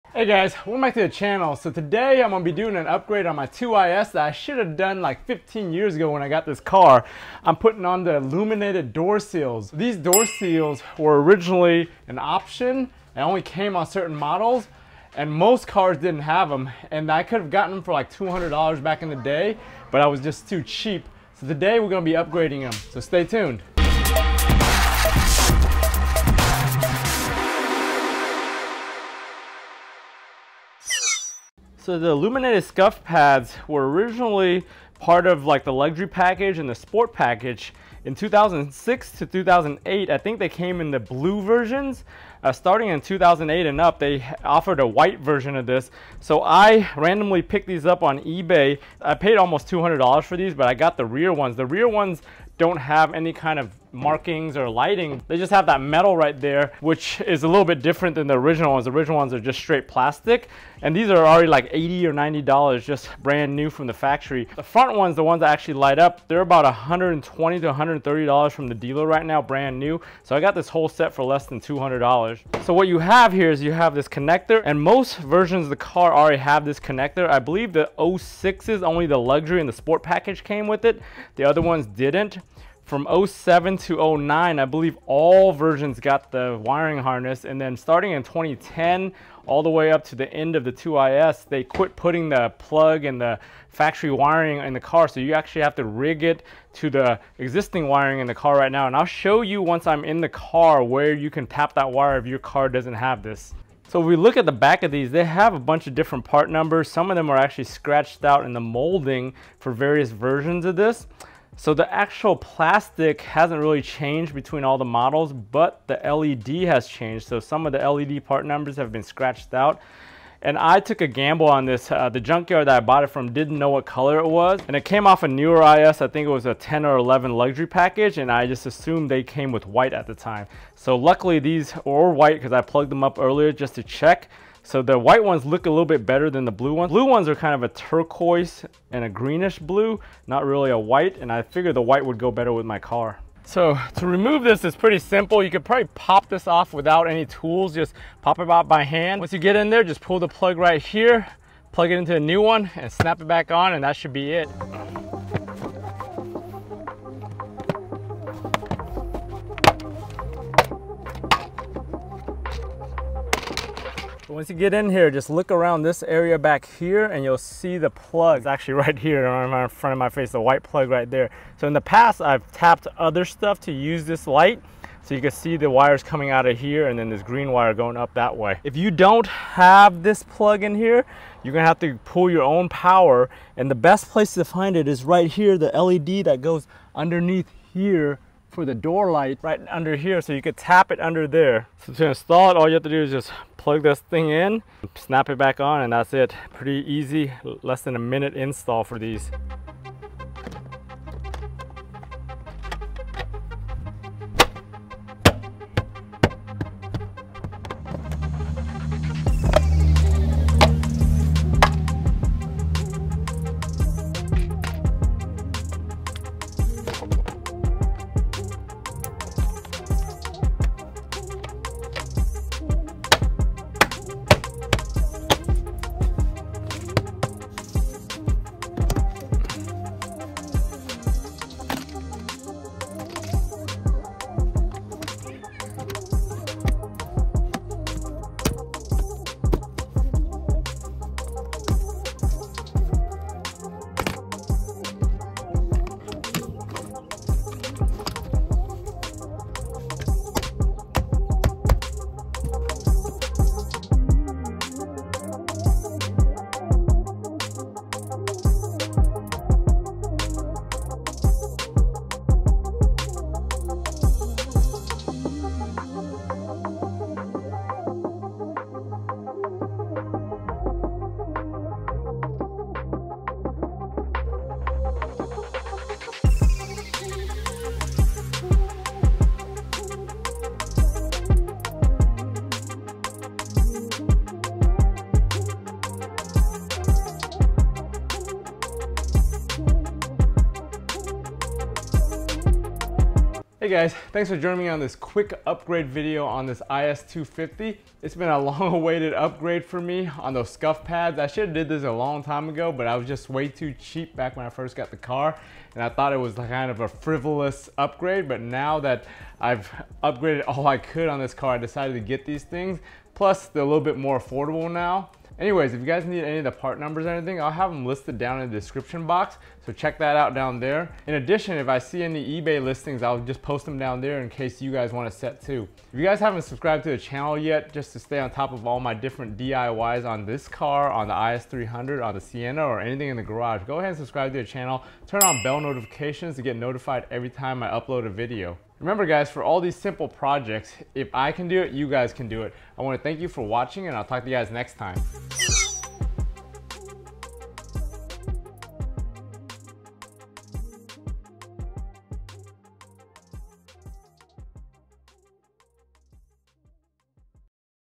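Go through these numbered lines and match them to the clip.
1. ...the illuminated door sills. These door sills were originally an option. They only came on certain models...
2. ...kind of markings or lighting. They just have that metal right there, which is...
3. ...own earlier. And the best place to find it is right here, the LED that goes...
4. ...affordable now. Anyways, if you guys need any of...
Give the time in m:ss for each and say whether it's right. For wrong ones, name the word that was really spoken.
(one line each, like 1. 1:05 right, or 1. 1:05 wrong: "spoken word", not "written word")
1. 0:08 right
2. 0:53 right
3. 3:02 wrong: "power", not "earlier"
4. 5:14 right.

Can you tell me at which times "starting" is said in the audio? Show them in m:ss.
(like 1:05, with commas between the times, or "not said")
0:42, 1:27.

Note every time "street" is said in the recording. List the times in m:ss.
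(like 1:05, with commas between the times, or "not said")
not said.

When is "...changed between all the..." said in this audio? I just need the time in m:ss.
1:53.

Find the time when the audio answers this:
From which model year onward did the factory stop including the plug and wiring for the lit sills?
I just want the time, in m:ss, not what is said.
1:28.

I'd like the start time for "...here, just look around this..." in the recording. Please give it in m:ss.
2:44.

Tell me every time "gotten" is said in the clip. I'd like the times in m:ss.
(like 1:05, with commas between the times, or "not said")
0:17.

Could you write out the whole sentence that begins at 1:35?
So you actually have to rig it to the existing wiring in the car right now.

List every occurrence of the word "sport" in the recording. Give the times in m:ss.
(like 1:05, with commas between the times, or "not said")
0:36, 1:19.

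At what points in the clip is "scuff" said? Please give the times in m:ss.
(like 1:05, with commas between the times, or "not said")
0:32, 5:00.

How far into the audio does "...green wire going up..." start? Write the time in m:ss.
2:57.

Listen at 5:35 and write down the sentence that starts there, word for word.
Turn on bell notifications to get notified every time I upload a video.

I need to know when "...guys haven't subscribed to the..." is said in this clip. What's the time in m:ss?
5:26.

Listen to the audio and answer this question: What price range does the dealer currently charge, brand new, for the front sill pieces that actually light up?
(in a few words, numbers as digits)
$120 to $130.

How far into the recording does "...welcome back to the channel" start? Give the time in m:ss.
0:00.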